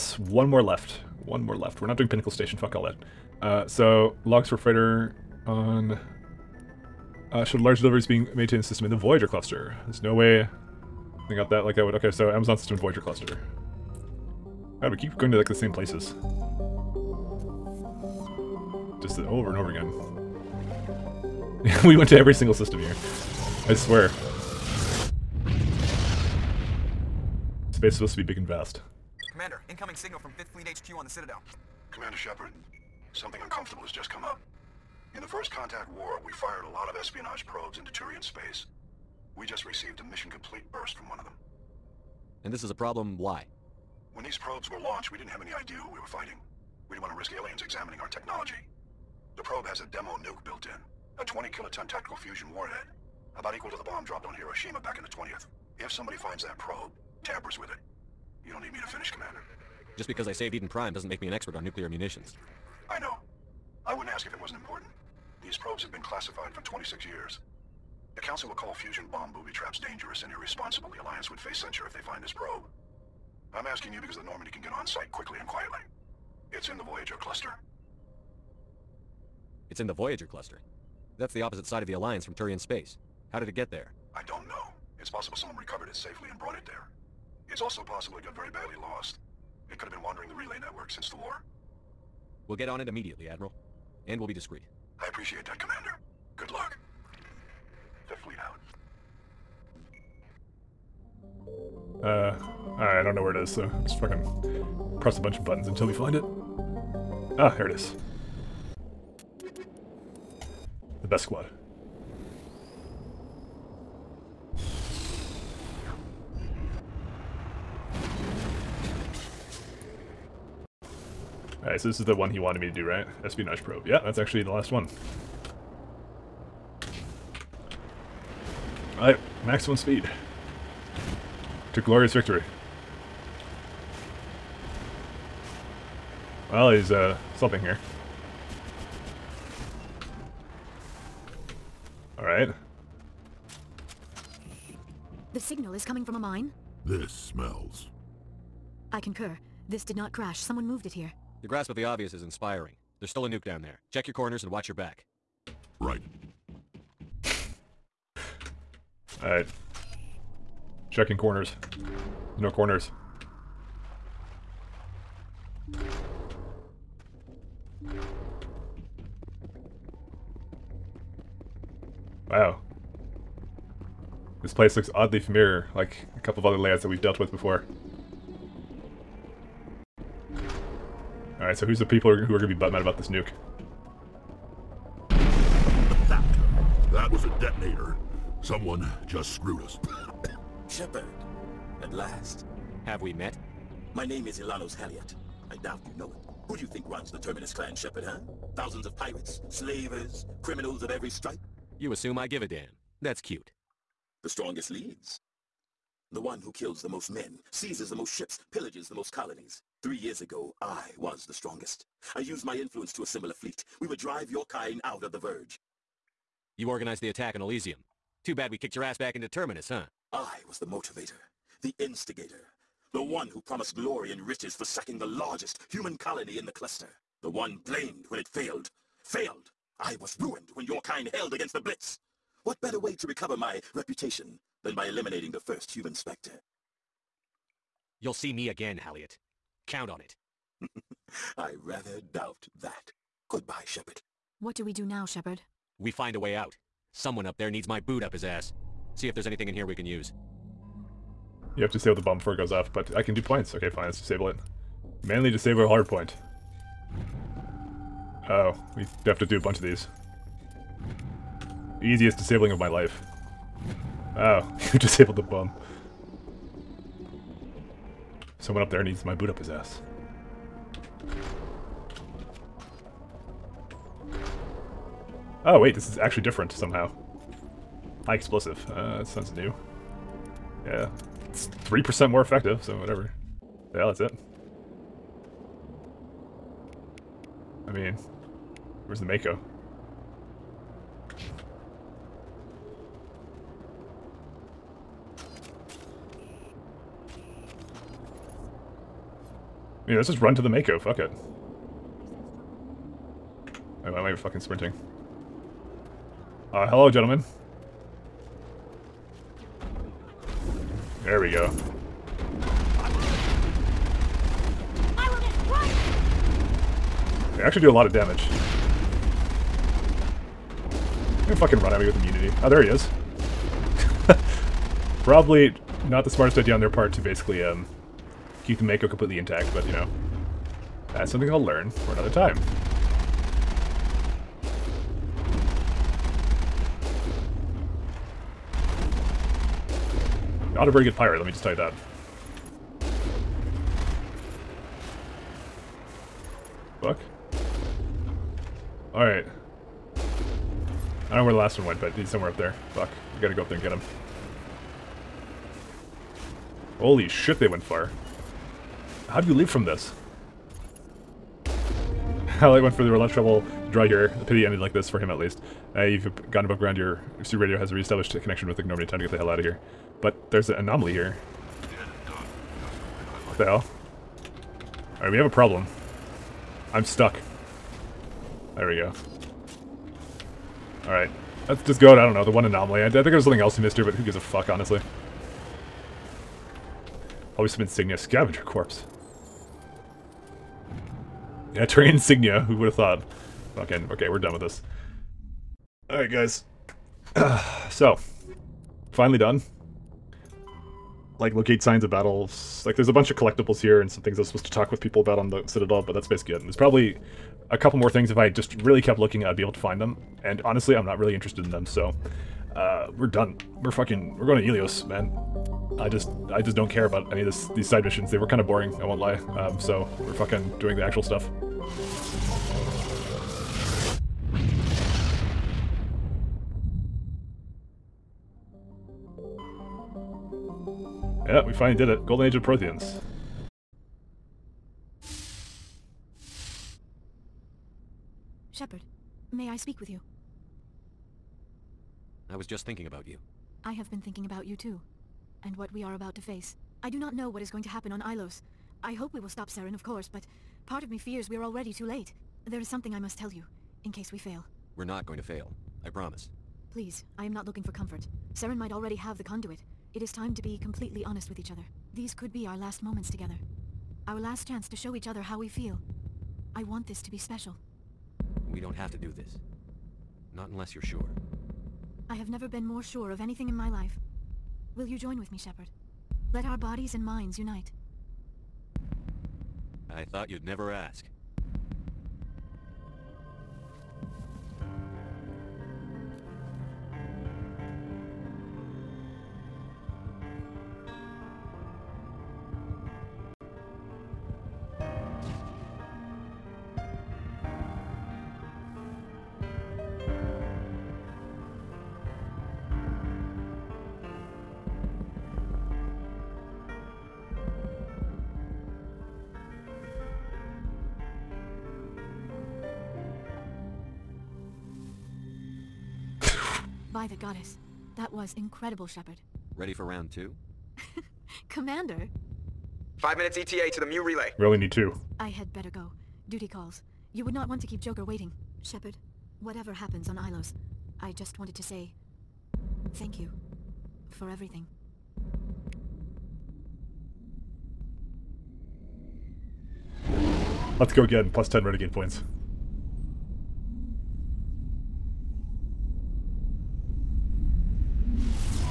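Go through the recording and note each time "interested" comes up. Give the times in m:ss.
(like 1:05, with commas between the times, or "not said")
6:51.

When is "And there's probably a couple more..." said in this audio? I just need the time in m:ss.
6:46.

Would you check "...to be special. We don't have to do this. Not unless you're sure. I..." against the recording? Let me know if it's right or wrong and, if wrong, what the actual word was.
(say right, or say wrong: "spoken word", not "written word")
right.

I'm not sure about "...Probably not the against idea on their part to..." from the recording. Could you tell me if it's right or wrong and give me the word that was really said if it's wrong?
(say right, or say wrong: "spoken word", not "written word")
wrong: "smartest", not "against".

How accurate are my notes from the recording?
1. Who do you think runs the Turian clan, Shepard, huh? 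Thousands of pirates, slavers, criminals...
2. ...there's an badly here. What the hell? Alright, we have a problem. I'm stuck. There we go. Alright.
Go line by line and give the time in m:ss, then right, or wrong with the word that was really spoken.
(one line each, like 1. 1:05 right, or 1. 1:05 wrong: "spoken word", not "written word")
1. 3:16 wrong: "Terminus", not "Turian"
2. 6:10 wrong: "anomaly", not "badly".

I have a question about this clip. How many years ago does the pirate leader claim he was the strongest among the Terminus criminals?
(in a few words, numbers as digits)
Three years.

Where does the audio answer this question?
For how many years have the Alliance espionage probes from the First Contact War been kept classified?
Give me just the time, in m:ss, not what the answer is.
1:06.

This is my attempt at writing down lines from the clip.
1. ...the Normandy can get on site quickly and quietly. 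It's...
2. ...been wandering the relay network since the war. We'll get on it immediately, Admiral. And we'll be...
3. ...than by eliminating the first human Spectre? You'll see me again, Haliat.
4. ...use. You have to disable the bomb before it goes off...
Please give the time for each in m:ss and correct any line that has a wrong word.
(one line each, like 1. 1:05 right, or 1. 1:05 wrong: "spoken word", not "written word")
1. 1:14 right
2. 1:29 right
3. 3:54 right
4. 4:09 right.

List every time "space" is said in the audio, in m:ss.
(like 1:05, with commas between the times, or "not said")
0:27, 0:38, 1:22.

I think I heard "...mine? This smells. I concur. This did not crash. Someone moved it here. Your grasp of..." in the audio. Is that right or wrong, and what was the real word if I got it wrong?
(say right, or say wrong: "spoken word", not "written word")
right.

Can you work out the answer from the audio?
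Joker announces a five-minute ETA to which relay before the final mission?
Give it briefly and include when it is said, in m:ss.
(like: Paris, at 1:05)
Mu relay, at 8:43.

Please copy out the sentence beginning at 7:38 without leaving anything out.
Saren might already have the conduit.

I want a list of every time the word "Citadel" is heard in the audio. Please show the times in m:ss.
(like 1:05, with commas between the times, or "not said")
0:31, 6:45.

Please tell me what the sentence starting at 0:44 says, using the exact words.
When these probes were launched, we didn't have any idea who we were fighting.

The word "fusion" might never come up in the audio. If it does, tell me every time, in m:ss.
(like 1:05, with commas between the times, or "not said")
0:52, 1:08.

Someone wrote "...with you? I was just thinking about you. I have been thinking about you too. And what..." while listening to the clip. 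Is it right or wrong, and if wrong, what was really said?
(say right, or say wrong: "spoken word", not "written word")
right.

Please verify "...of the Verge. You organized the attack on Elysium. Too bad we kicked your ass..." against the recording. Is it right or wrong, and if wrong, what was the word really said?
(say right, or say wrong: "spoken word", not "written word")
right.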